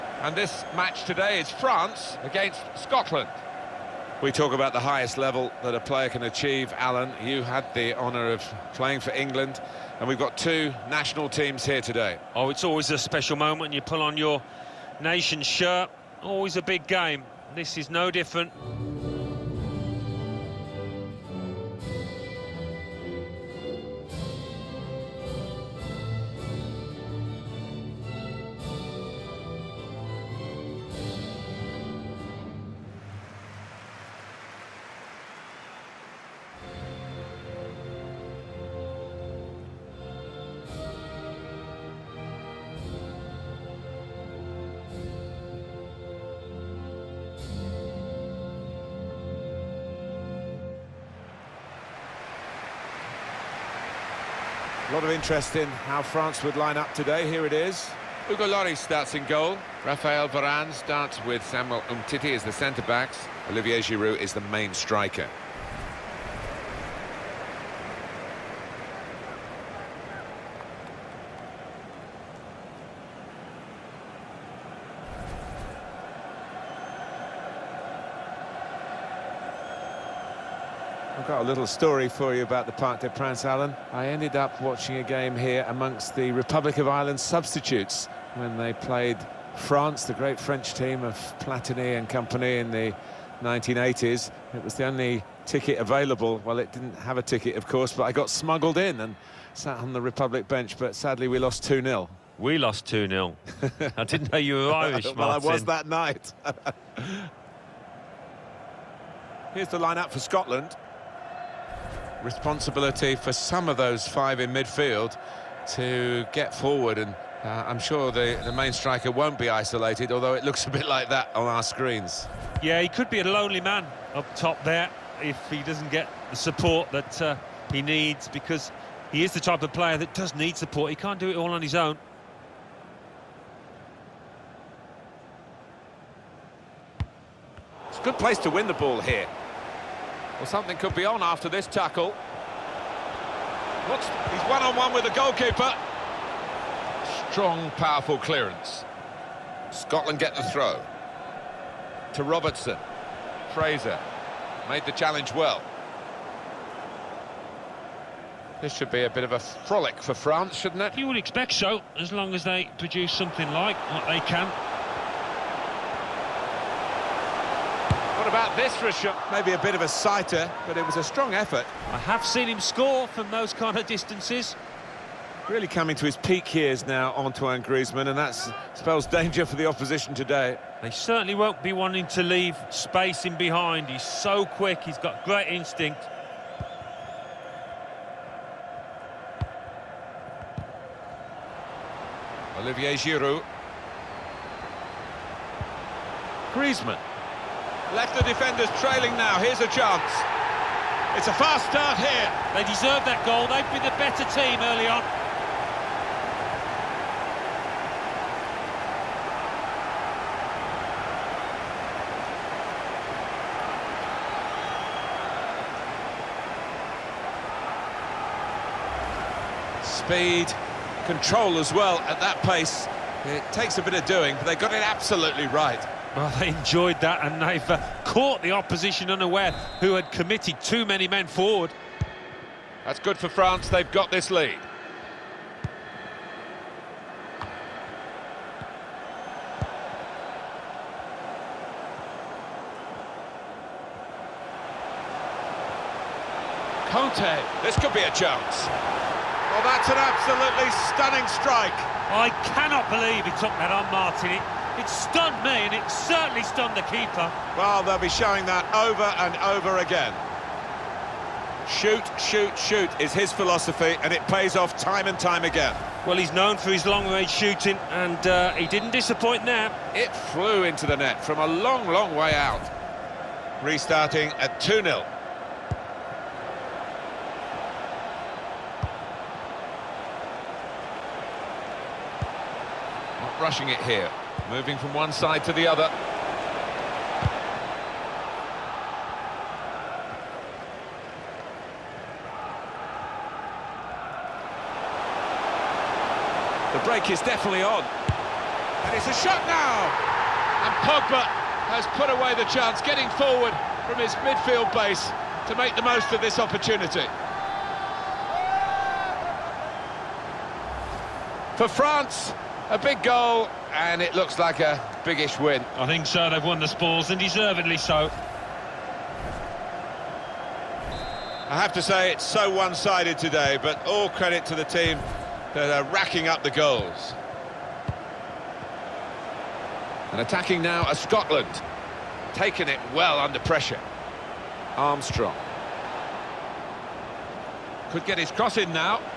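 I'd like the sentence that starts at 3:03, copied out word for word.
He's so quick, he's got great instinct.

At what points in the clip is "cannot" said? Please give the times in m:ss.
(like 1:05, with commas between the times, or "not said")
4:12.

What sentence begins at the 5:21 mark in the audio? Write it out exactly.
I have to say, it's so one-sided today, but all credit to the team that are racking up the goals.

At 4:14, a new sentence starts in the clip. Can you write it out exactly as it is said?
It it stunned me, and it certainly stunned the keeper.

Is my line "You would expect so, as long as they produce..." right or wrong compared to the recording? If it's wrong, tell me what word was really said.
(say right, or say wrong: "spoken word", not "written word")
right.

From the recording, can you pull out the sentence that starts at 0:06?
Alan, you had the honour of playing for England, and we've got two national teams here today.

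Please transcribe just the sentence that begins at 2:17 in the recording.
It's a good place to win the ball here.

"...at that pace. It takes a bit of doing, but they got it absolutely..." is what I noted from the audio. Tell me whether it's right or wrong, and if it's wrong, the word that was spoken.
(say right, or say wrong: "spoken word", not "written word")
right.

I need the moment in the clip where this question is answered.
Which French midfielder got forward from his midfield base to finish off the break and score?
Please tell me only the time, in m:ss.
5:00.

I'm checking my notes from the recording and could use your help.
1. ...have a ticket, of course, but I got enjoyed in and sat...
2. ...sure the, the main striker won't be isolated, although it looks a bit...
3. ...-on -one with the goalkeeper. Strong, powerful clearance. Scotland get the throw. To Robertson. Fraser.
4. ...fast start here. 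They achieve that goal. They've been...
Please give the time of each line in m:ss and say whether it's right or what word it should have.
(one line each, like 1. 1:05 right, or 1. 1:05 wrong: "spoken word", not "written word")
1. 1:36 wrong: "smuggled", not "enjoyed"
2. 1:57 right
3. 2:24 right
4. 3:21 wrong: "deserve", not "achieve".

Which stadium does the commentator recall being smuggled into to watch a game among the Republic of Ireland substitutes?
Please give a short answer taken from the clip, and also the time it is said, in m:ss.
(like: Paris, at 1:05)
Parc des Princes, at 1:22.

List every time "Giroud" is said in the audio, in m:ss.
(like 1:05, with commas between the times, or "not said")
1:03, 3:12.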